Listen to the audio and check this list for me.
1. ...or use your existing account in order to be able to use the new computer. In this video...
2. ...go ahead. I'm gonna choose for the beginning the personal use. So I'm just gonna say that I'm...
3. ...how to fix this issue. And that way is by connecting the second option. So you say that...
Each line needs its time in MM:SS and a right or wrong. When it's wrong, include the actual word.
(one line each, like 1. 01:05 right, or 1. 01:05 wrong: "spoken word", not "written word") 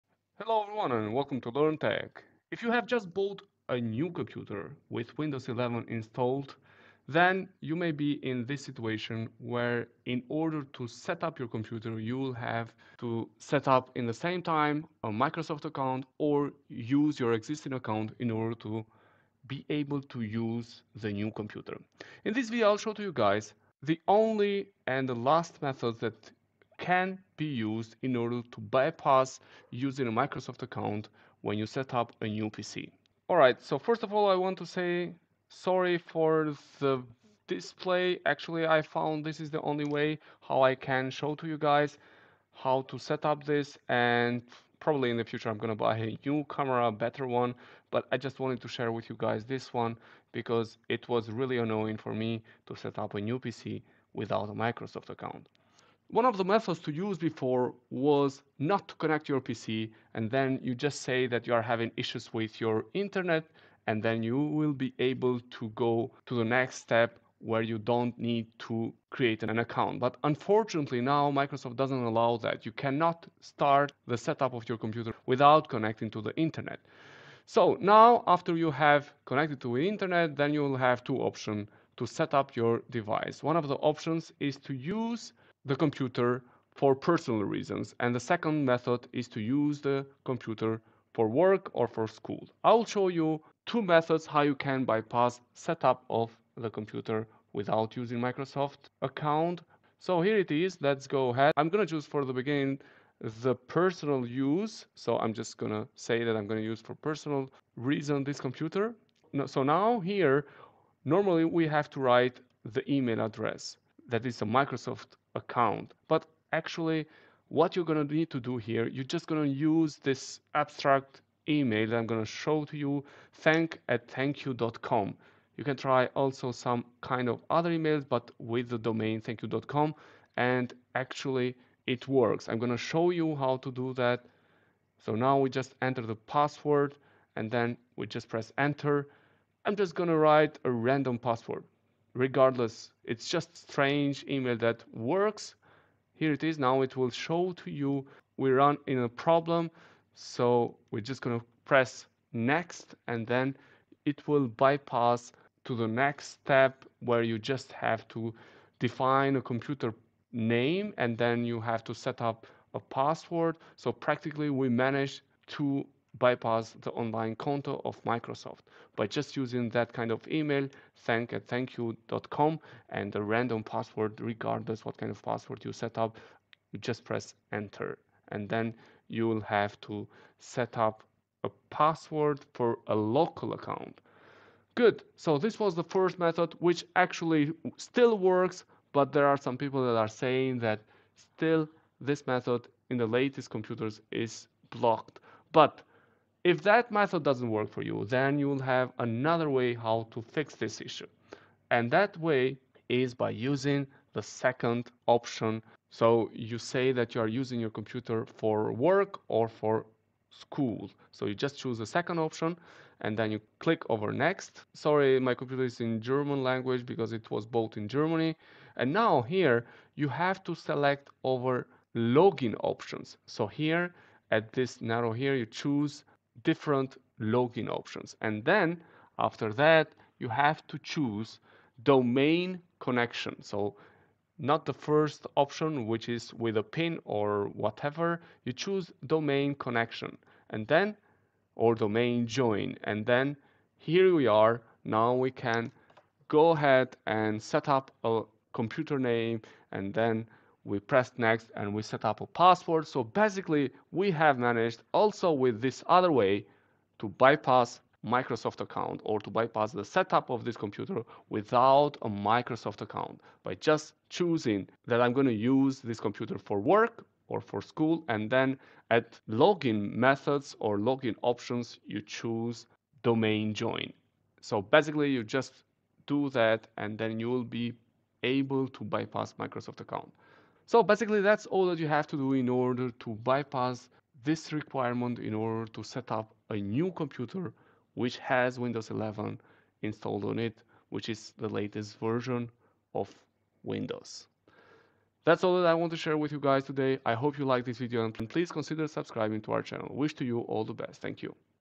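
1. 00:16 right
2. 01:41 right
3. 03:19 wrong: "using", not "connecting".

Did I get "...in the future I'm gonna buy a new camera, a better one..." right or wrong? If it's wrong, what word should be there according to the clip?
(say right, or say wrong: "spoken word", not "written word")
right.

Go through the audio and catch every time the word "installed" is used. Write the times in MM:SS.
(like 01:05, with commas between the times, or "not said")
00:05, 04:49.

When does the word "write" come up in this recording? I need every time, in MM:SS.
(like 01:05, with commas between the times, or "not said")
01:51, 02:20.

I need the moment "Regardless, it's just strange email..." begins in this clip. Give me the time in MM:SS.
02:22.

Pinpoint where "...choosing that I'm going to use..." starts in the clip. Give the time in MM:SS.
04:24.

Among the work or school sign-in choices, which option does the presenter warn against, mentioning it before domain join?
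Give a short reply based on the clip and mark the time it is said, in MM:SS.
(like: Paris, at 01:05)
PIN, at 03:56.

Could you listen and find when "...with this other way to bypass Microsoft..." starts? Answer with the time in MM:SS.
04:15.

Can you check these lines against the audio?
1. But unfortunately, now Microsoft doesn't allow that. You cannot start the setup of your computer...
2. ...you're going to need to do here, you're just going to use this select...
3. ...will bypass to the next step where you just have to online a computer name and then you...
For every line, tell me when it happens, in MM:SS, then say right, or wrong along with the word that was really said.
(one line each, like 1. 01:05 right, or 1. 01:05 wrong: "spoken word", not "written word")
1. 01:10 right
2. 01:57 wrong: "abstract", not "select"
3. 02:34 wrong: "define", not "online".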